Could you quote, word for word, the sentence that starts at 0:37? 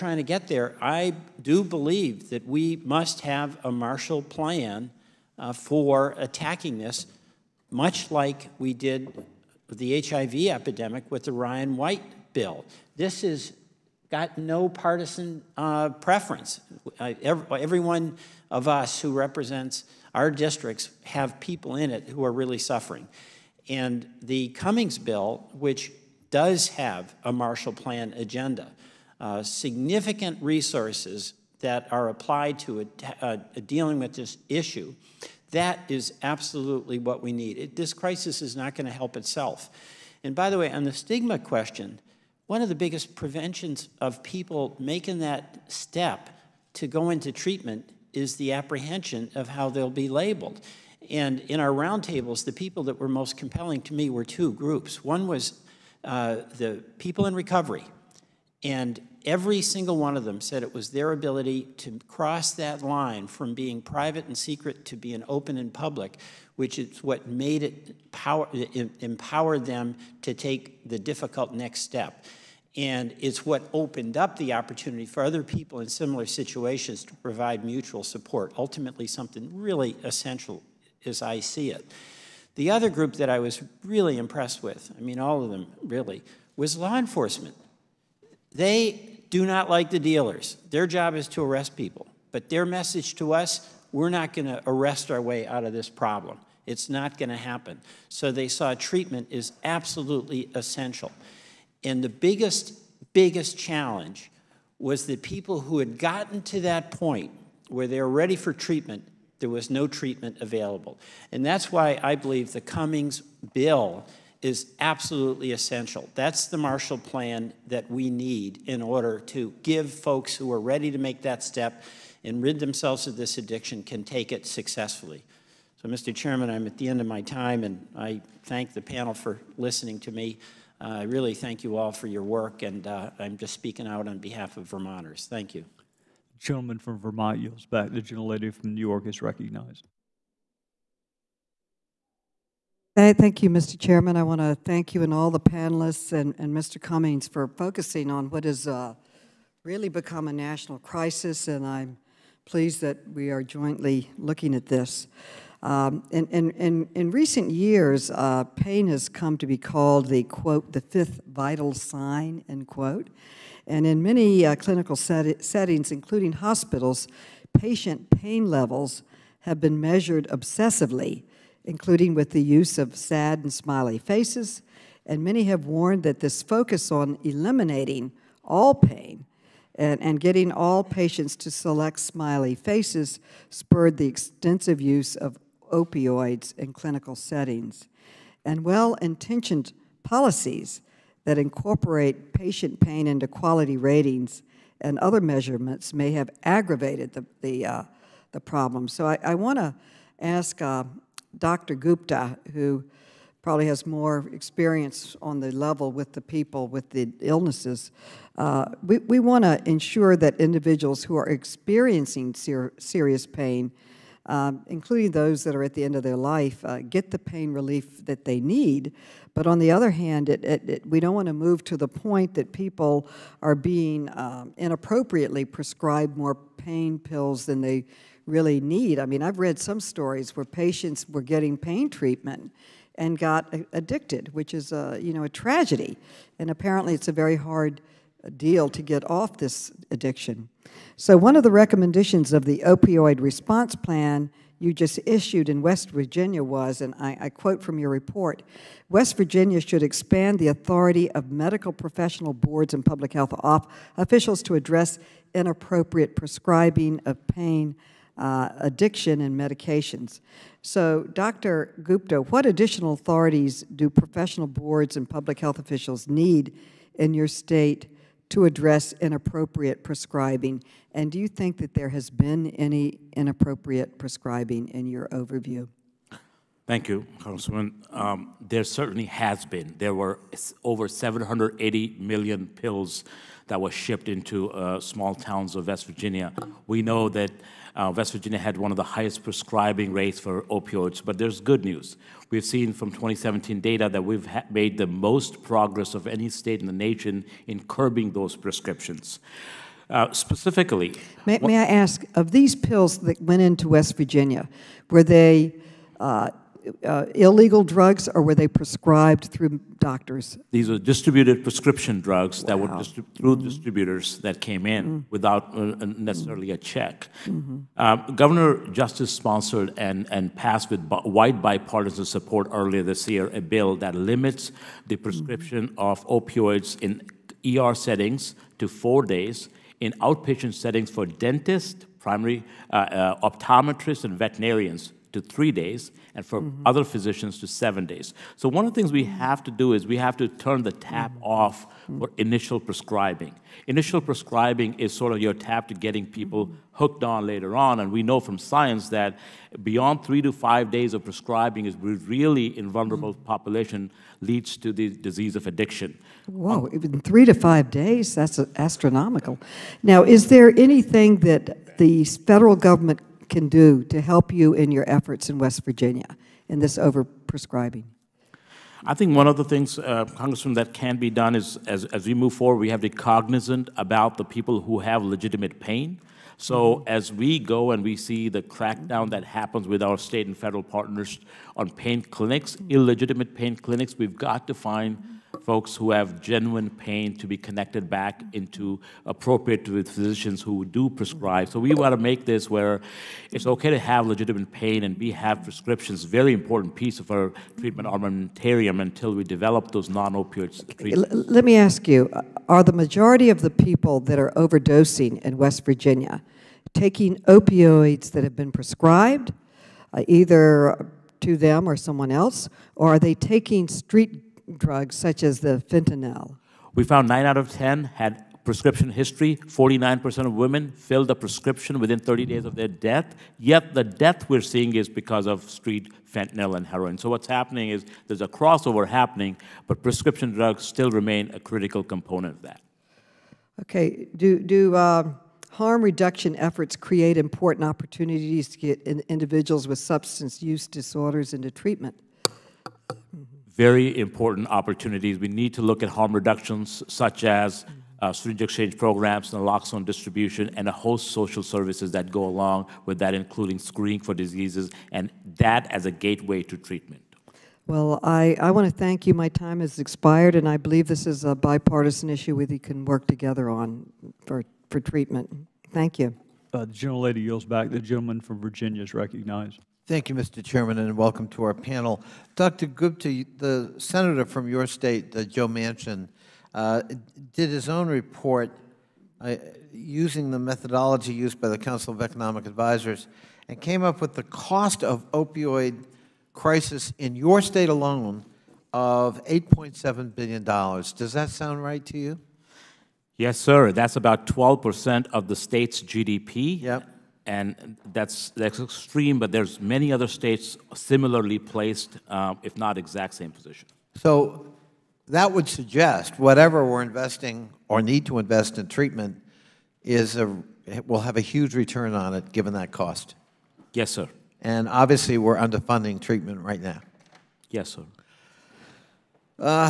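It, this crisis is not going to help itself.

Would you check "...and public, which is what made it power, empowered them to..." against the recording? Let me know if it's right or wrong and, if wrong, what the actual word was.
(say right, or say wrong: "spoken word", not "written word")
right.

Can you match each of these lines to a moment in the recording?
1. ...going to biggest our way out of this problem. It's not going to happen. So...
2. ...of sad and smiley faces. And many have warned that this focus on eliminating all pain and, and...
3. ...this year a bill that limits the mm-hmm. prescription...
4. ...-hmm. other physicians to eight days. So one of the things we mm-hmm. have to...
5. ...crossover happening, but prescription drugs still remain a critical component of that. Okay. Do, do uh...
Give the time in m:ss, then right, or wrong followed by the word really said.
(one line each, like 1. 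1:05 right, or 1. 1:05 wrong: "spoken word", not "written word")
1. 1:34 wrong: "arrest", not "biggest"
2. 2:52 right
3. 5:22 right
4. 5:36 wrong: "seven", not "eight"
5. 7:08 right.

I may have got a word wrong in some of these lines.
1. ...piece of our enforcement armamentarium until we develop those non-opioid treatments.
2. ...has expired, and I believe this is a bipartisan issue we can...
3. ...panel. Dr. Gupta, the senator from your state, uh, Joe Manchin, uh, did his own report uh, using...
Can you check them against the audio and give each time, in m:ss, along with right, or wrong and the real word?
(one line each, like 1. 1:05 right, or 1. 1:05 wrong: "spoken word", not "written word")
1. 6:36 wrong: "treatment", not "enforcement"
2. 7:39 right
3. 7:51 right.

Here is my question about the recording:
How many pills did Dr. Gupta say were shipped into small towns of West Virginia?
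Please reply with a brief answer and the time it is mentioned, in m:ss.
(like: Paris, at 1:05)
780 million, at 4:40.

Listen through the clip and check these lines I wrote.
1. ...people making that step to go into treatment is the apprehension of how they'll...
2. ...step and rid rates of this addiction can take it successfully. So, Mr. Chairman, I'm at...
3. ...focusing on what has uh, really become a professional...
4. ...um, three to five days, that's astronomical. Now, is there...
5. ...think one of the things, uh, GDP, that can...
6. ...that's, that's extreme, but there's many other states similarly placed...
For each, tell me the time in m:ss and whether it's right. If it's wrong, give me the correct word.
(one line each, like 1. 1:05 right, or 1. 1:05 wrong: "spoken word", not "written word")
1. 0:44 right
2. 2:01 wrong: "themselves", not "rates"
3. 2:27 wrong: "national", not "professional"
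4. 5:56 right
5. 6:08 wrong: "Congressman", not "GDP"
6. 8:17 right.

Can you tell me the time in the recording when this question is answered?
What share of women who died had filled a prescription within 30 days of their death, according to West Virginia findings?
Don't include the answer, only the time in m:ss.
6:59.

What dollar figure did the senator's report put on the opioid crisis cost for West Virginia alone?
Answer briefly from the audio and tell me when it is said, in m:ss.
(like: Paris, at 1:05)
$8.7 billion, at 8:09.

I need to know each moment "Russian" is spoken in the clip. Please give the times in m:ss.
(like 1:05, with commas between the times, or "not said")
not said.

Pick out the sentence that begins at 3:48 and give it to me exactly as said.
I mean, I've read some stories where patients were getting pain treatment and got addicted, which is a, you know a tragedy.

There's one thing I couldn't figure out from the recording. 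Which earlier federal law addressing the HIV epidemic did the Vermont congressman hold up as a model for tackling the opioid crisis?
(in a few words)
Ryan White bill.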